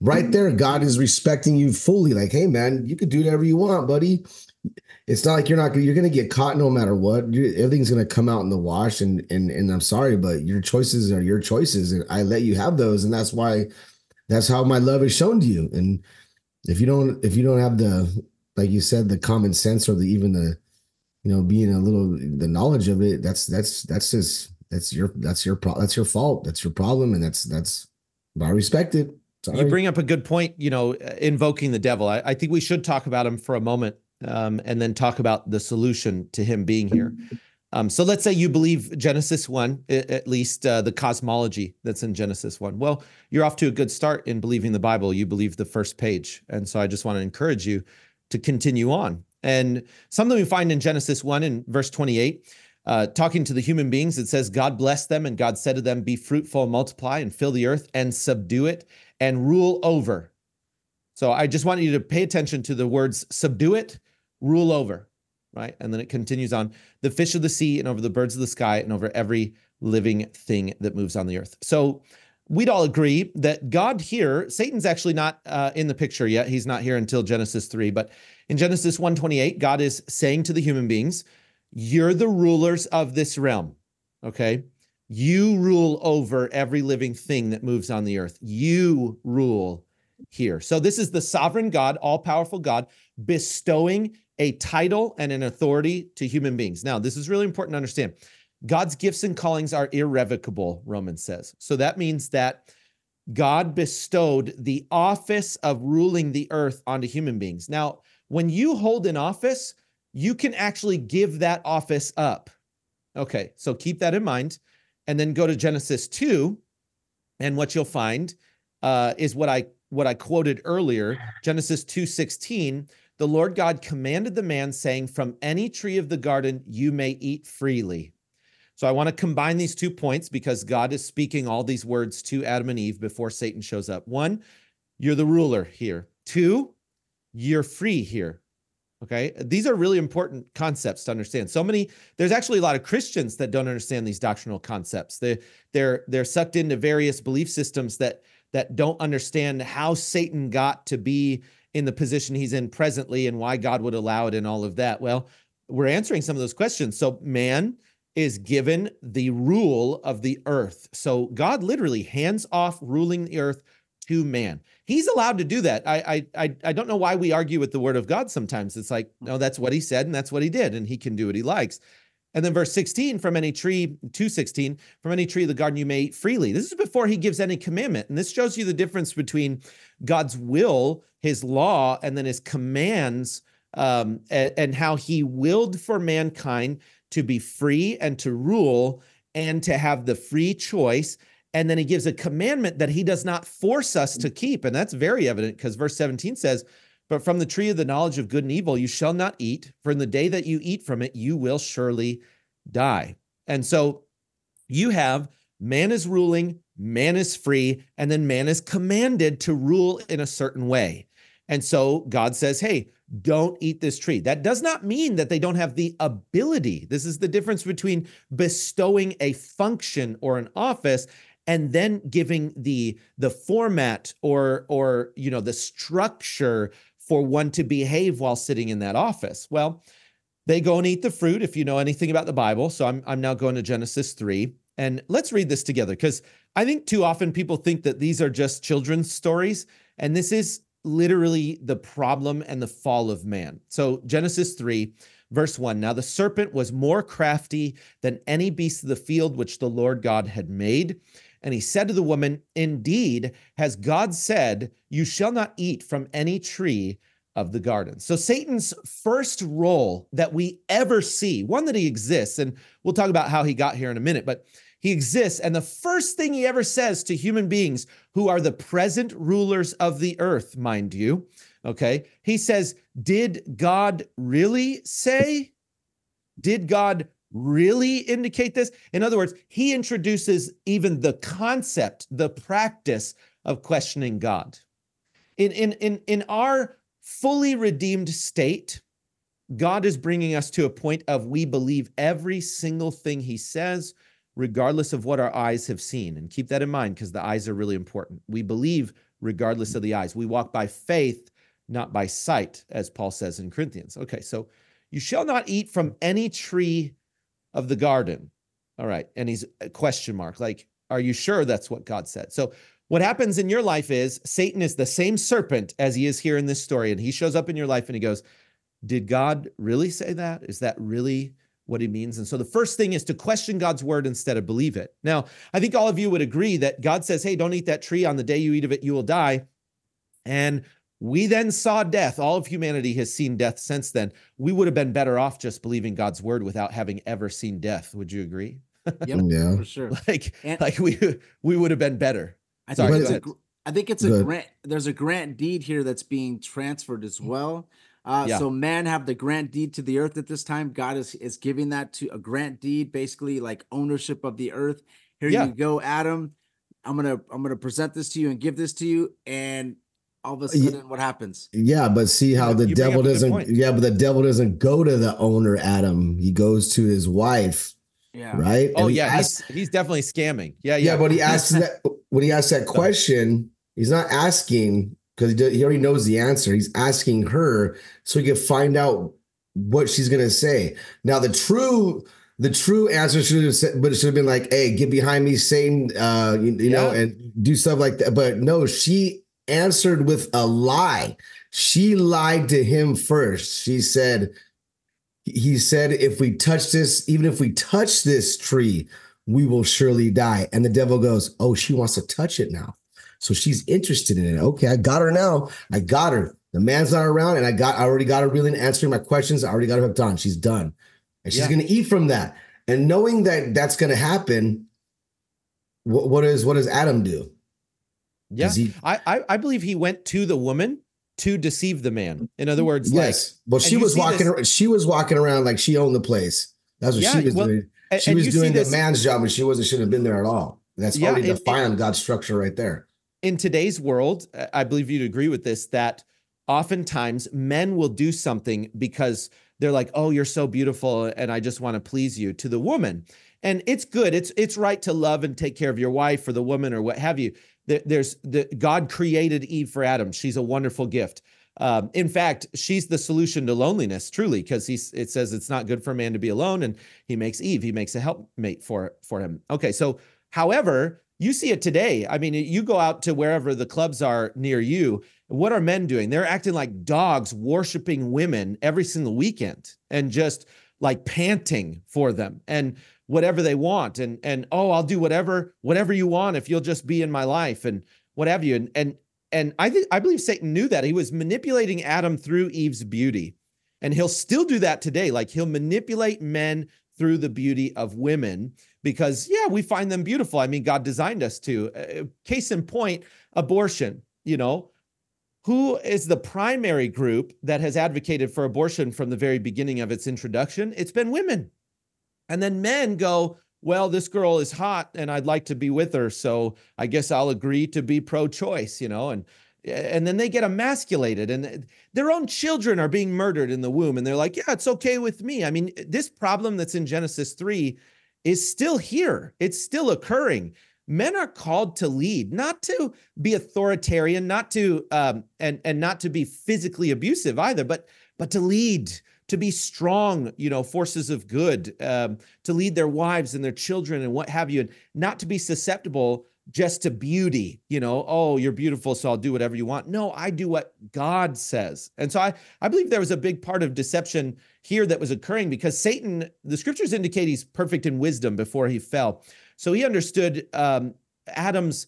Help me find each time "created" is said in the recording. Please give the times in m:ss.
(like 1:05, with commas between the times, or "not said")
7:28.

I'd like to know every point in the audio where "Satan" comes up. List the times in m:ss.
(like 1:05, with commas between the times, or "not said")
1:14, 2:13, 2:29, 4:18, 5:14, 6:25, 8:00, 9:05.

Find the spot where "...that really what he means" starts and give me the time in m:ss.
5:20.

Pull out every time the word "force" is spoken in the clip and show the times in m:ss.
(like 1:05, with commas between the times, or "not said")
3:13, 8:50.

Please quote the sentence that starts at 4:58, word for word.
We believe regardless of the eyes.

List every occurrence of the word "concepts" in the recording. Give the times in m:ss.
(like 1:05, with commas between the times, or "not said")
2:20, 2:24, 4:41.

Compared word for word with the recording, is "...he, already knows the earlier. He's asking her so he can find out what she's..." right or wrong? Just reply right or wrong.
wrong.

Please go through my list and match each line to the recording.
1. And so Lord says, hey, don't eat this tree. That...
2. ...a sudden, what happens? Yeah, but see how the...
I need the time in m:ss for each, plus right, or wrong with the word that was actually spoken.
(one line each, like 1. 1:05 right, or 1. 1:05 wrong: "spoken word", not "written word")
1. 3:31 wrong: "God", not "Lord"
2. 6:00 right.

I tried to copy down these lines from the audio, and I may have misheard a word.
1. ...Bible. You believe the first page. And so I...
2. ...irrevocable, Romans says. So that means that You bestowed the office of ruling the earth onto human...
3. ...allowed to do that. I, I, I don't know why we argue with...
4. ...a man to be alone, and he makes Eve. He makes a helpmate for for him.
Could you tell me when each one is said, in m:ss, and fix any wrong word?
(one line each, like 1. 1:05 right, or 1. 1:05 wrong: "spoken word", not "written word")
1. 0:44 right
2. 1:39 wrong: "God", not "You"
3. 2:45 right
4. 7:35 right.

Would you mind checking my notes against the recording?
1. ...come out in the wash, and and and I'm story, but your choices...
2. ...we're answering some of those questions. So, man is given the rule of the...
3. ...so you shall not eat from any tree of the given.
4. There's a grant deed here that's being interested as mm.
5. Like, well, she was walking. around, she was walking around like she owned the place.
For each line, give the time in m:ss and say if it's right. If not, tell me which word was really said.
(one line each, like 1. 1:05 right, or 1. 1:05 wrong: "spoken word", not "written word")
1. 0:08 wrong: "sorry", not "story"
2. 2:35 right
3. 5:04 wrong: "garden", not "given"
4. 5:44 wrong: "transferred", not "interested"
5. 7:03 right.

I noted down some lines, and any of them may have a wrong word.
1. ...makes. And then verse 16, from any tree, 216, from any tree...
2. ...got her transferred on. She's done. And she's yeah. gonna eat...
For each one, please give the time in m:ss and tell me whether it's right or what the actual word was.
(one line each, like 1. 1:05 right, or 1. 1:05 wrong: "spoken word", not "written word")
1. 2:51 wrong: "likes", not "makes"
2. 6:49 wrong: "hooked", not "transferred".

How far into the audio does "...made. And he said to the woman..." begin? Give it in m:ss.
4:10.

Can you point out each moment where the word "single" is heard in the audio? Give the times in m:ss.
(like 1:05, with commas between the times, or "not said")
4:52, 7:48.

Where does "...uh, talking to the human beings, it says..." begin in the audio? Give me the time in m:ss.
0:52.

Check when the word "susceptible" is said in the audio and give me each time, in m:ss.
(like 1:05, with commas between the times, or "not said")
8:55.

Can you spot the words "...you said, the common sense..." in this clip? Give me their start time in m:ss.
0:18.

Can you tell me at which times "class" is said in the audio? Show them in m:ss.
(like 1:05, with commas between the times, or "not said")
not said.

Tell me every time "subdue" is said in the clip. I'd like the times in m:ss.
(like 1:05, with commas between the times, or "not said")
0:58, 1:03.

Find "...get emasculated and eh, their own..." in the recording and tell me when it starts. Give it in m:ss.
8:30.